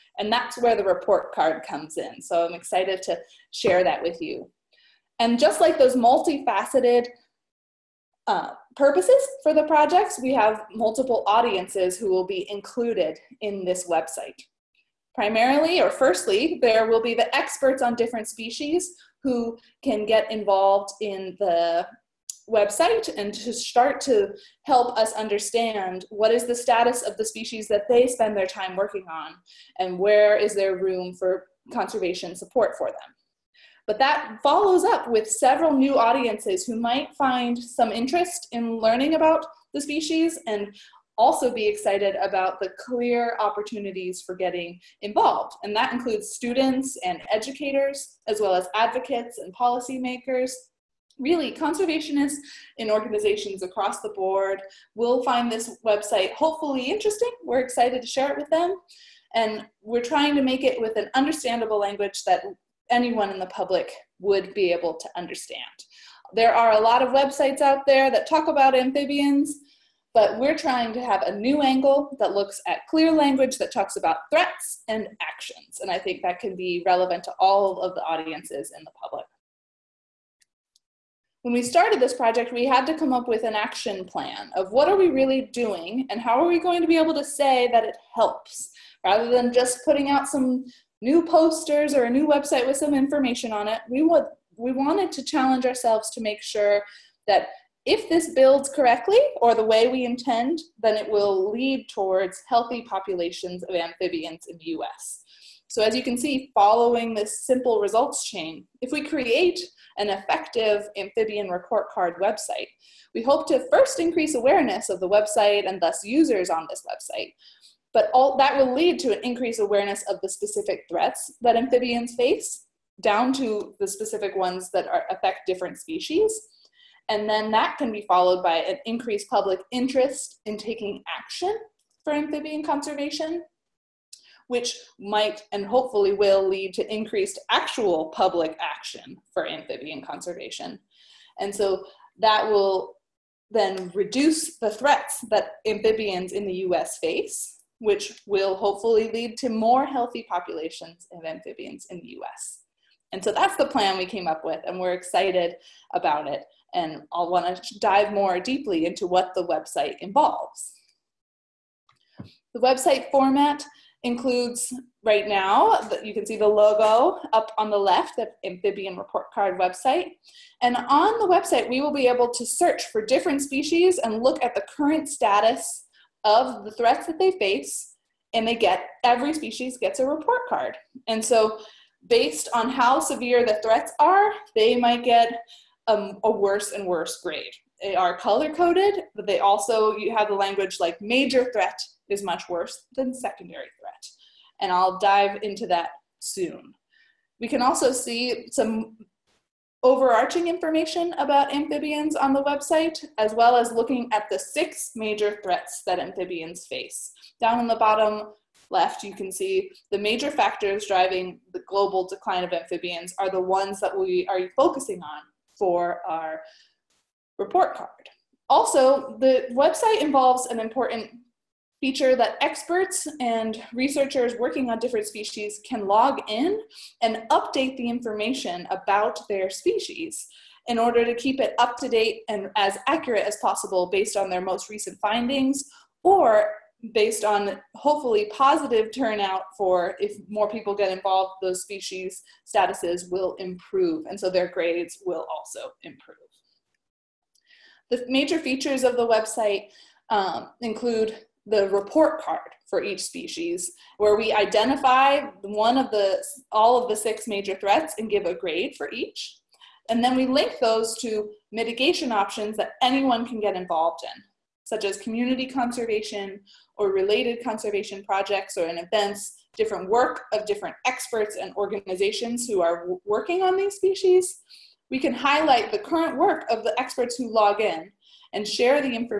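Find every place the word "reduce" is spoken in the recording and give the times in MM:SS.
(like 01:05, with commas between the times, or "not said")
02:23.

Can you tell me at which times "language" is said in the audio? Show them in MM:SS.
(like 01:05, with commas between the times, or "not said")
01:01, 01:13, 03:10.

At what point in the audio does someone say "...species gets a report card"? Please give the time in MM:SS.
02:59.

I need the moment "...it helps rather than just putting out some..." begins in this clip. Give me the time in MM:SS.
01:27.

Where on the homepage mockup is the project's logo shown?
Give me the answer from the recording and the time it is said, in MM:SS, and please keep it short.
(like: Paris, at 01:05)
up on the left, at 02:47.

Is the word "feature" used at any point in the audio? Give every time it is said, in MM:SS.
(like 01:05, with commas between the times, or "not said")
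03:41, 04:08.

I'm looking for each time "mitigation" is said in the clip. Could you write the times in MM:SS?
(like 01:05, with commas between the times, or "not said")
04:21.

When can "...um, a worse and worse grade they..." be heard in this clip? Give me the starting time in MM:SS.
03:05.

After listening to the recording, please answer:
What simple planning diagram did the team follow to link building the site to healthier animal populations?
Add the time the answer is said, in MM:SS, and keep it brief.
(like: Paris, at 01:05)
results chain, at 01:47.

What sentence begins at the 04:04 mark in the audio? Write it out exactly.
And so their grades will also improve.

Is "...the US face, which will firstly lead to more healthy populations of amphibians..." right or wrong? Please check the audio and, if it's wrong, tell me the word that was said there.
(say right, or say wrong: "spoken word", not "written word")
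wrong: "hopefully", not "firstly".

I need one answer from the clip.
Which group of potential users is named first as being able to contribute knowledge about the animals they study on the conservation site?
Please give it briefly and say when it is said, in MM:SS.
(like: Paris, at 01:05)
experts on different species, at 00:17.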